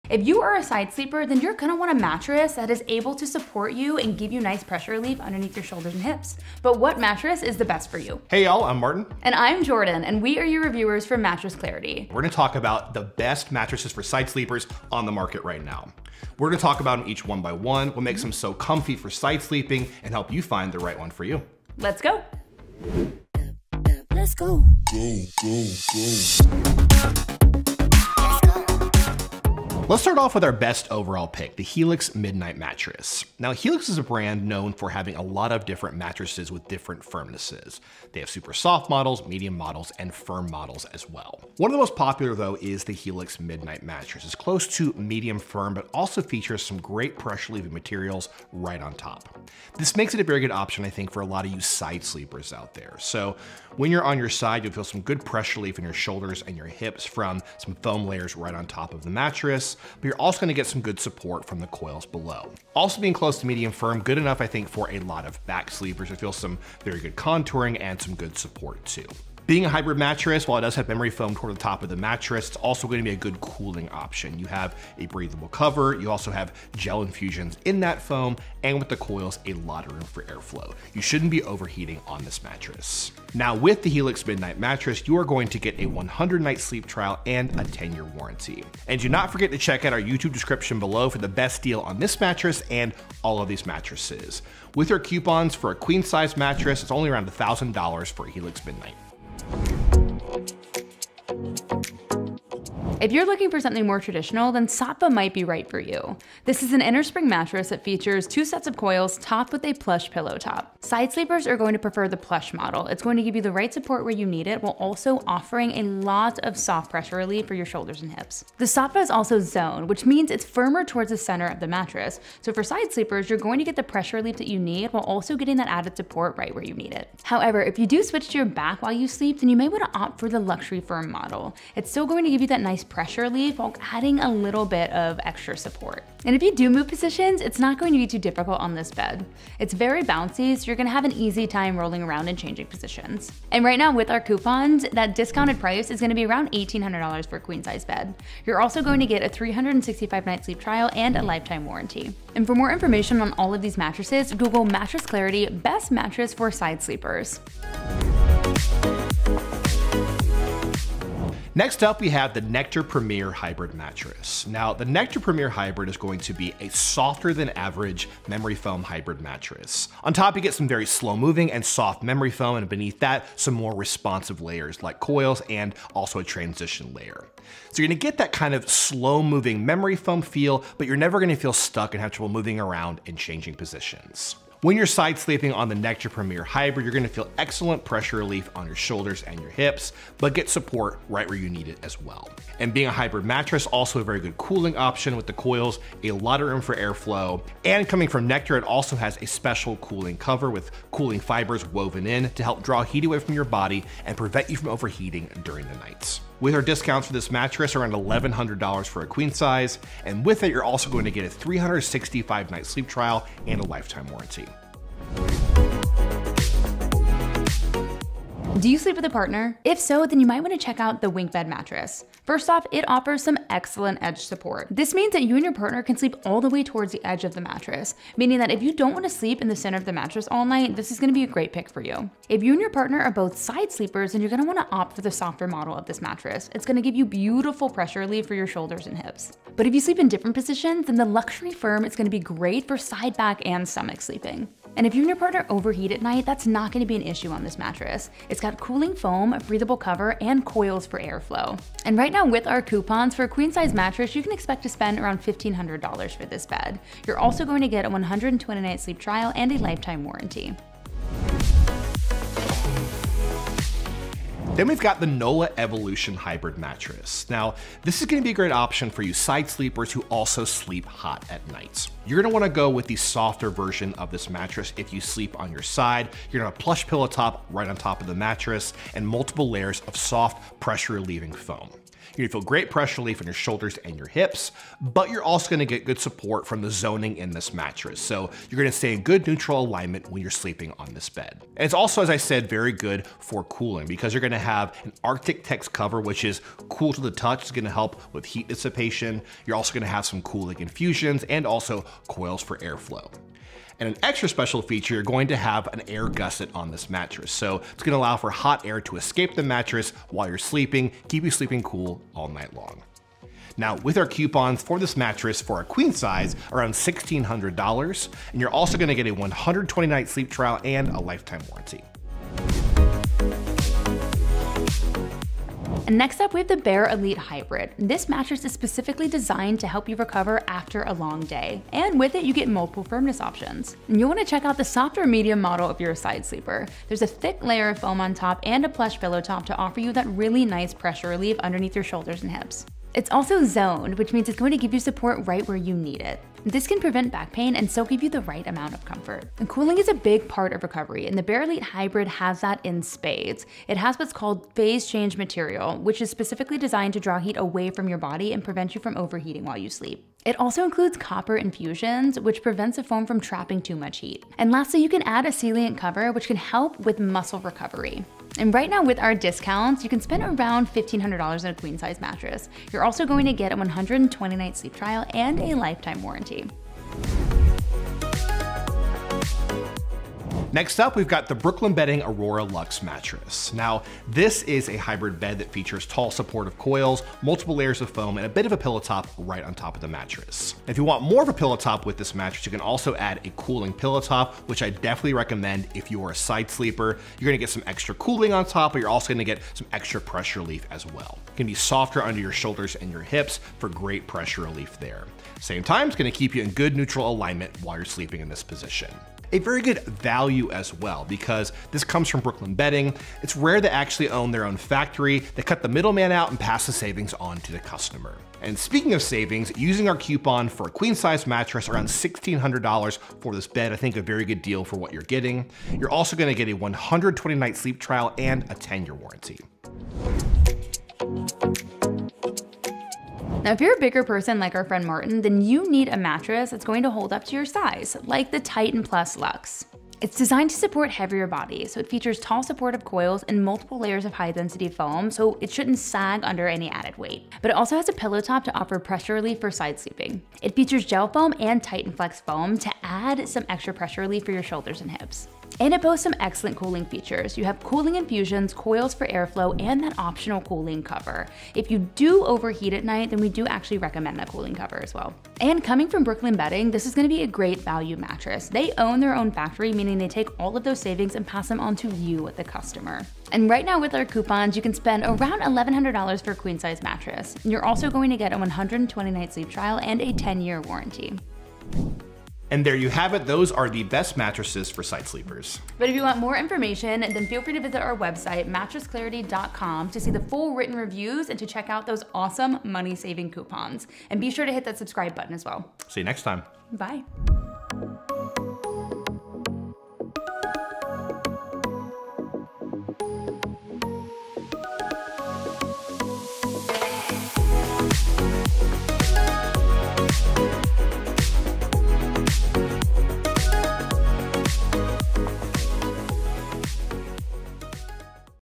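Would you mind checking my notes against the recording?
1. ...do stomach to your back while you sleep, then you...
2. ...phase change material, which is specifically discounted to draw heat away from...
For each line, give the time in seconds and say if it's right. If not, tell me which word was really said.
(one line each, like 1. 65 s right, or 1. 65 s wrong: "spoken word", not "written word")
1. 127 s wrong: "switch", not "stomach"
2. 354 s wrong: "designed", not "discounted".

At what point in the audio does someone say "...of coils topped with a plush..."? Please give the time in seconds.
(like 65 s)
108 s.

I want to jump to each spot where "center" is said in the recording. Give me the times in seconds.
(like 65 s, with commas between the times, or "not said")
121 s, 229 s.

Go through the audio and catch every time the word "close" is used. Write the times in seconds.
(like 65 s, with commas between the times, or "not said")
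44 s, 63 s.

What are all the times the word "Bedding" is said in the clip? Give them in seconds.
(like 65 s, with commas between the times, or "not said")
381 s, 412 s, 466 s.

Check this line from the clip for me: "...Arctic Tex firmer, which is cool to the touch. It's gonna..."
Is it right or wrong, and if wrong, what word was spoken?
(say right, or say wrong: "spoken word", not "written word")
wrong: "cover", not "firmer".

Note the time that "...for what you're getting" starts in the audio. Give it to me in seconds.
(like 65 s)
424 s.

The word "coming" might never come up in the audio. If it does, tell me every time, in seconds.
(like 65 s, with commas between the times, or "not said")
197 s, 465 s.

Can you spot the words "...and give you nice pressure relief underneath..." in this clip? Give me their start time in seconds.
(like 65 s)
3 s.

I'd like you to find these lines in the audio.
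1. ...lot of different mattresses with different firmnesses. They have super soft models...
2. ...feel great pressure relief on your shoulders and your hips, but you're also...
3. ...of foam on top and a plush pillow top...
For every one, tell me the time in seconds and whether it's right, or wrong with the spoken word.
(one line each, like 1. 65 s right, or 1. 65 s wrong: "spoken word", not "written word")
1. 35 s right
2. 282 s right
3. 337 s right.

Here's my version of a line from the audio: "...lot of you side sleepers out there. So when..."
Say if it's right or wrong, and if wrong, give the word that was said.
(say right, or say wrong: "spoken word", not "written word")
right.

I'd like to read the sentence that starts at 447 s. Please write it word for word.
But it also has a pillow top to offer pressure relief for side sleeping.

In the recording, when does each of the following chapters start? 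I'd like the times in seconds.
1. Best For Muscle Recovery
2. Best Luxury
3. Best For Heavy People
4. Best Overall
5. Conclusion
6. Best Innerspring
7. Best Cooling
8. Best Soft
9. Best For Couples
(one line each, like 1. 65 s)
1. 323 s
2. 158 s
3. 431 s
4. 27 s
5. 482 s
6. 101 s
7. 262 s
8. 379 s
9. 217 s.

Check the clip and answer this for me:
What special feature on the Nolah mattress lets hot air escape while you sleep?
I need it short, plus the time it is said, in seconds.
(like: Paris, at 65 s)
air gusset, at 305 s.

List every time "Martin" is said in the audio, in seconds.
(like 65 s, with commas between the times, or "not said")
8 s, 434 s.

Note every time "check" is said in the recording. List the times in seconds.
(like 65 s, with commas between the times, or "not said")
89 s, 220 s, 334 s, 491 s.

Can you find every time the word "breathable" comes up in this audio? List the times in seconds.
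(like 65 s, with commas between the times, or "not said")
75 s, 249 s.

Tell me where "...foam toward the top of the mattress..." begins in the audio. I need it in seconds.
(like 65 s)
71 s.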